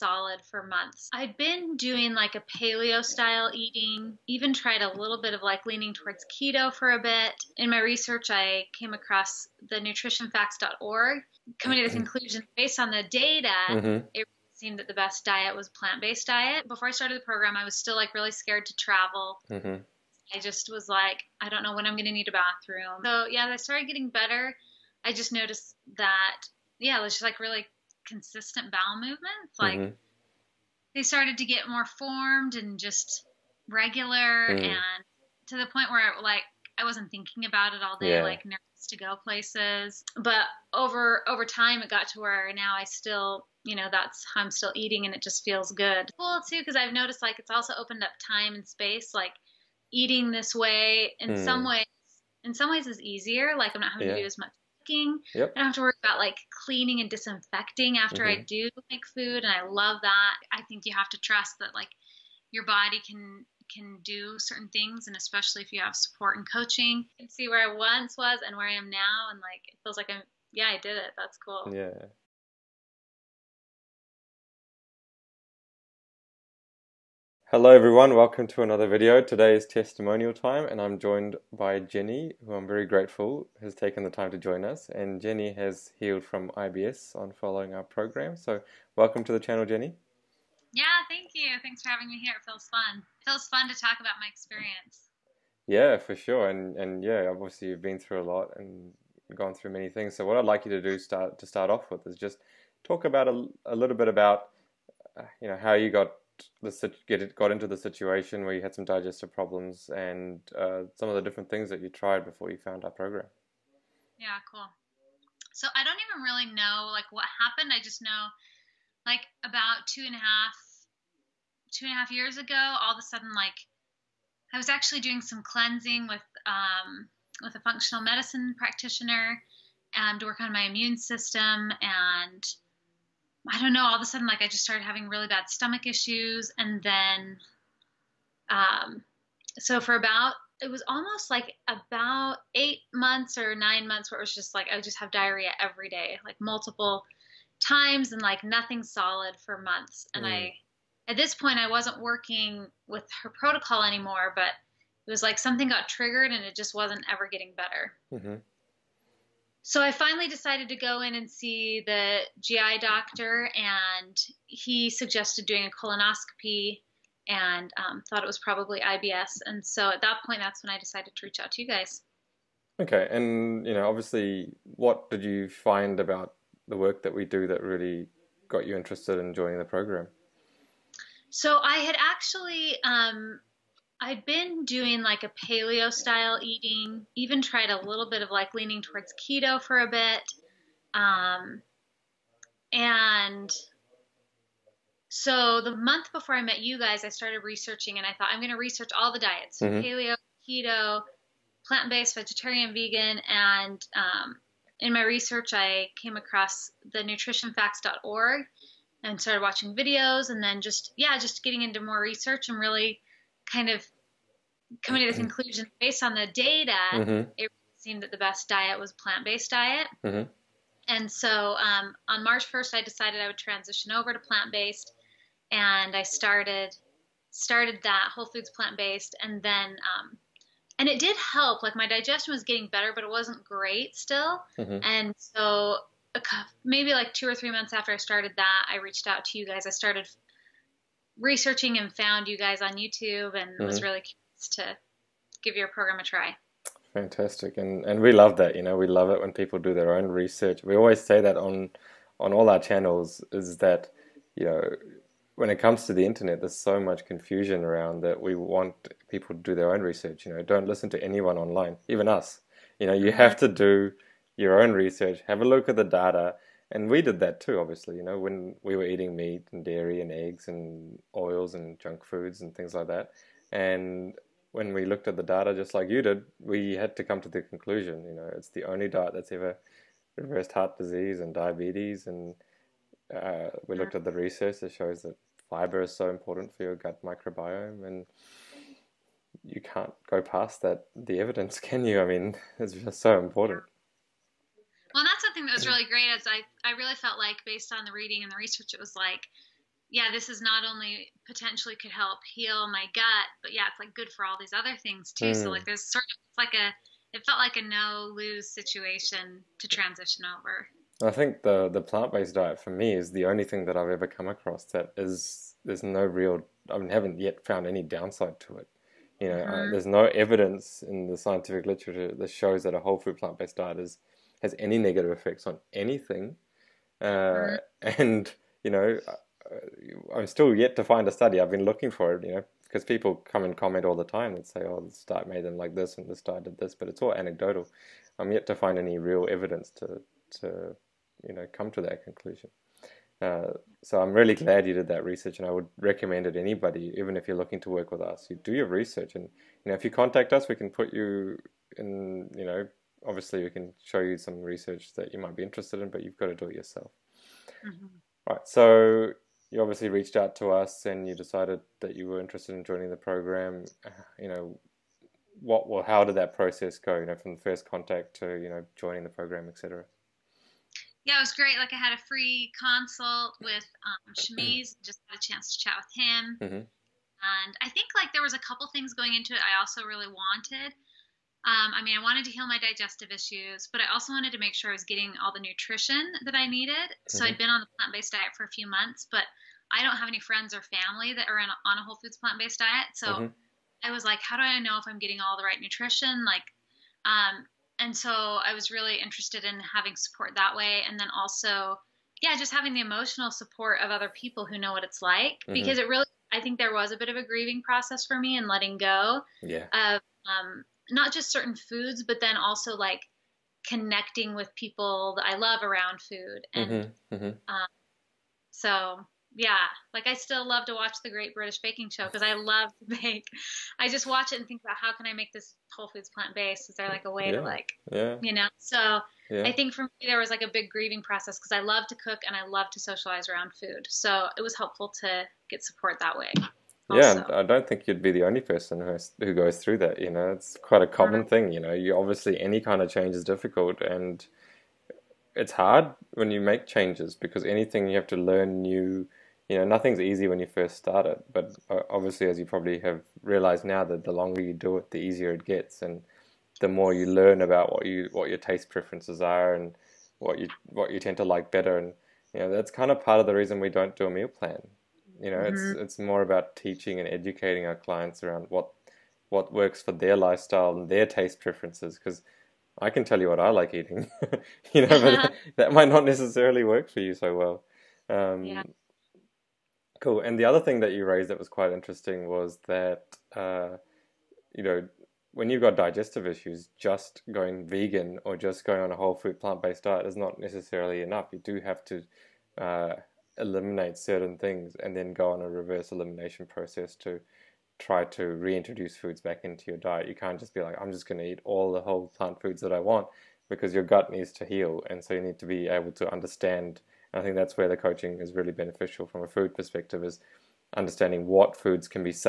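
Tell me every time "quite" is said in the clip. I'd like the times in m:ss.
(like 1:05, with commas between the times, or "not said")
7:20, 8:01.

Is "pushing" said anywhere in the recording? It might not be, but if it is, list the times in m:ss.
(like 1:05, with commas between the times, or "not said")
not said.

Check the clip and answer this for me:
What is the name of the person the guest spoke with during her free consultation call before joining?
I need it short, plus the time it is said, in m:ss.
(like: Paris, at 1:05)
Shamiz, at 6:14.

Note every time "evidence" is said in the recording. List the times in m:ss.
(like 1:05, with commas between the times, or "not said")
4:51, 5:20, 5:39.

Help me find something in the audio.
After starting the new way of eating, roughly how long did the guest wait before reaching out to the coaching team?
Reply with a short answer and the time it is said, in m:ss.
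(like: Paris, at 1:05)
2 or 3 months, at 3:57.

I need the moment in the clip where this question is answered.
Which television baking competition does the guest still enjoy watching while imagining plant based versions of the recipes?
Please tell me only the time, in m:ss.
7:01.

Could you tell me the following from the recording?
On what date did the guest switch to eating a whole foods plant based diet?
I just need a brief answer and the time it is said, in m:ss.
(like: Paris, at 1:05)
March 1st, at 3:42.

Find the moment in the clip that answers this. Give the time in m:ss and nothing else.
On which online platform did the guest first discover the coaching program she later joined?
4:02.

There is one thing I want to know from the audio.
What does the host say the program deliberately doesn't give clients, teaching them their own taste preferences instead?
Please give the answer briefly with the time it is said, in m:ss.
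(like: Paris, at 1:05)
A meal plan, at 7:44.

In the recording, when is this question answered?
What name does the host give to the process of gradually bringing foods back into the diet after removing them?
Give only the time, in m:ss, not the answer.
8:15.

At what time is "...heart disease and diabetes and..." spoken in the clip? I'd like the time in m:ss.
4:40.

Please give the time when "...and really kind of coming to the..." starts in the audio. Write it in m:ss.
3:32.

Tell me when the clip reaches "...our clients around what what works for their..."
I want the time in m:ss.
7:47.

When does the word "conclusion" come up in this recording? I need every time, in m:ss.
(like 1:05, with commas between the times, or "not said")
0:12, 3:35, 4:37, 5:42.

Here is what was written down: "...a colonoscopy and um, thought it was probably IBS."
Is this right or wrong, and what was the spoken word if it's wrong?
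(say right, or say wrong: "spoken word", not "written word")
right.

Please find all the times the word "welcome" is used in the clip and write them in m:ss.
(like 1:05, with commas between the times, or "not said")
1:18, 1:28.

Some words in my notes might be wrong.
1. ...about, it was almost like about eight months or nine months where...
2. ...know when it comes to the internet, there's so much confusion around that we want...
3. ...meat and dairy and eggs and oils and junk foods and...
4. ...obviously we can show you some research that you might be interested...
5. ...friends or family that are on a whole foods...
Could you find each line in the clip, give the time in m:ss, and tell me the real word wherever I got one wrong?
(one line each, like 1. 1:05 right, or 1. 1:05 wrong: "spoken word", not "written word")
1. 2:19 right
2. 4:14 right
3. 4:29 right
4. 5:53 right
5. 6:30 right.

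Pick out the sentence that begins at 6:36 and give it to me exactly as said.
Like, um, and so I was really interested in having support that way.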